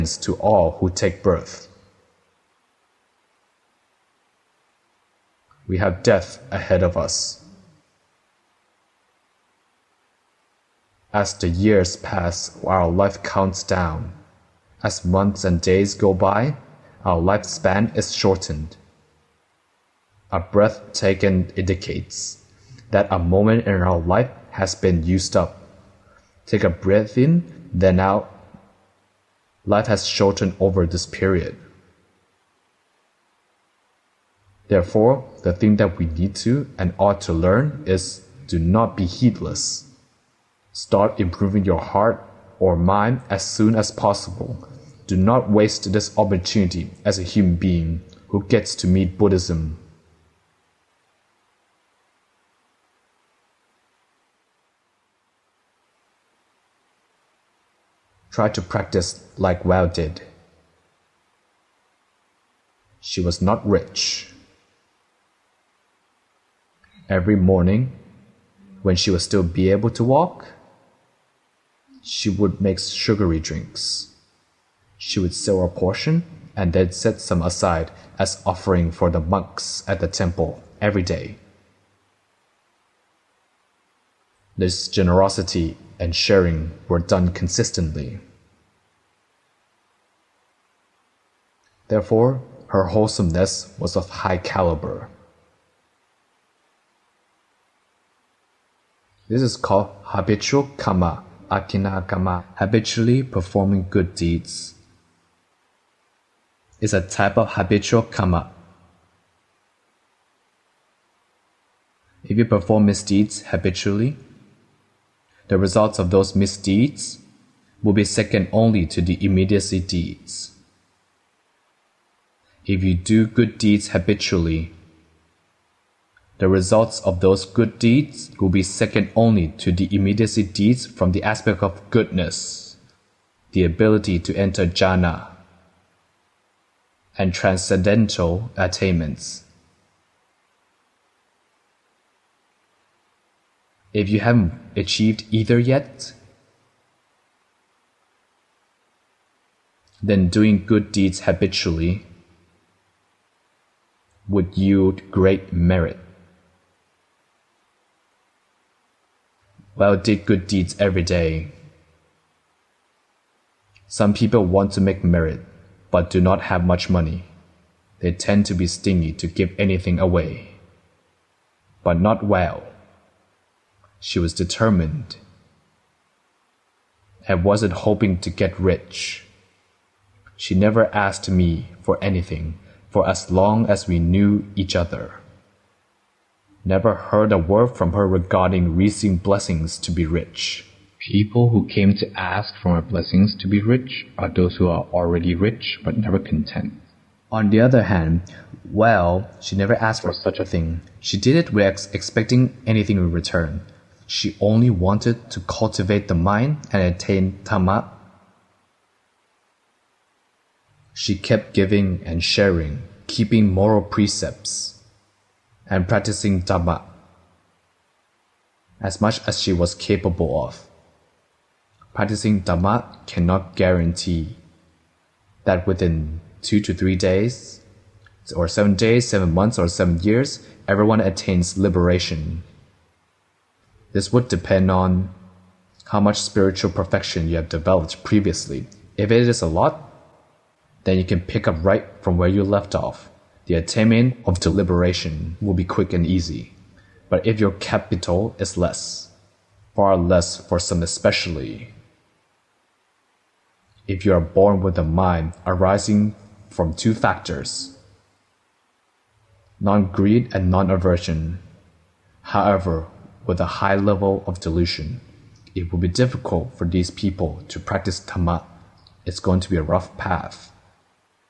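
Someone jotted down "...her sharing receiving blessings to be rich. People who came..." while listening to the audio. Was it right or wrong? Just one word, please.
wrong.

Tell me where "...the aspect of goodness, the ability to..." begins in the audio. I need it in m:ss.
2:11.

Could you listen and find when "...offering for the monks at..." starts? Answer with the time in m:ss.
1:18.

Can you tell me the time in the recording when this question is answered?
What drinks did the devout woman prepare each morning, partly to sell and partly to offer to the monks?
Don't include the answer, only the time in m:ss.
1:12.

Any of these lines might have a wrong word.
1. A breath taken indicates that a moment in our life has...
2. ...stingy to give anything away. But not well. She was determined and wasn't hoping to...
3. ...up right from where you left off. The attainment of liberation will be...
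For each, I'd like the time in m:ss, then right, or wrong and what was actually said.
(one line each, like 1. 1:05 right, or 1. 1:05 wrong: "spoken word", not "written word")
1. 0:20 right
2. 2:48 right
3. 4:01 wrong: "deliberation", not "liberation".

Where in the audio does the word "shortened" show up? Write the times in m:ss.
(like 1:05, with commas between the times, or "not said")
0:18, 0:30.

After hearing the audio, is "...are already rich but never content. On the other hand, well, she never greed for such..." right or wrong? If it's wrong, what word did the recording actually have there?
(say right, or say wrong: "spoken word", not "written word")
wrong: "asked", not "greed".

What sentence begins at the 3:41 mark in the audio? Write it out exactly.
Practicing Dhamma cannot guarantee that within two to three days, or seven days, seven months, or seven years, everyone attains liberation.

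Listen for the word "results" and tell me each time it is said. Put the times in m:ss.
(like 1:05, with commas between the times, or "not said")
1:55, 2:06.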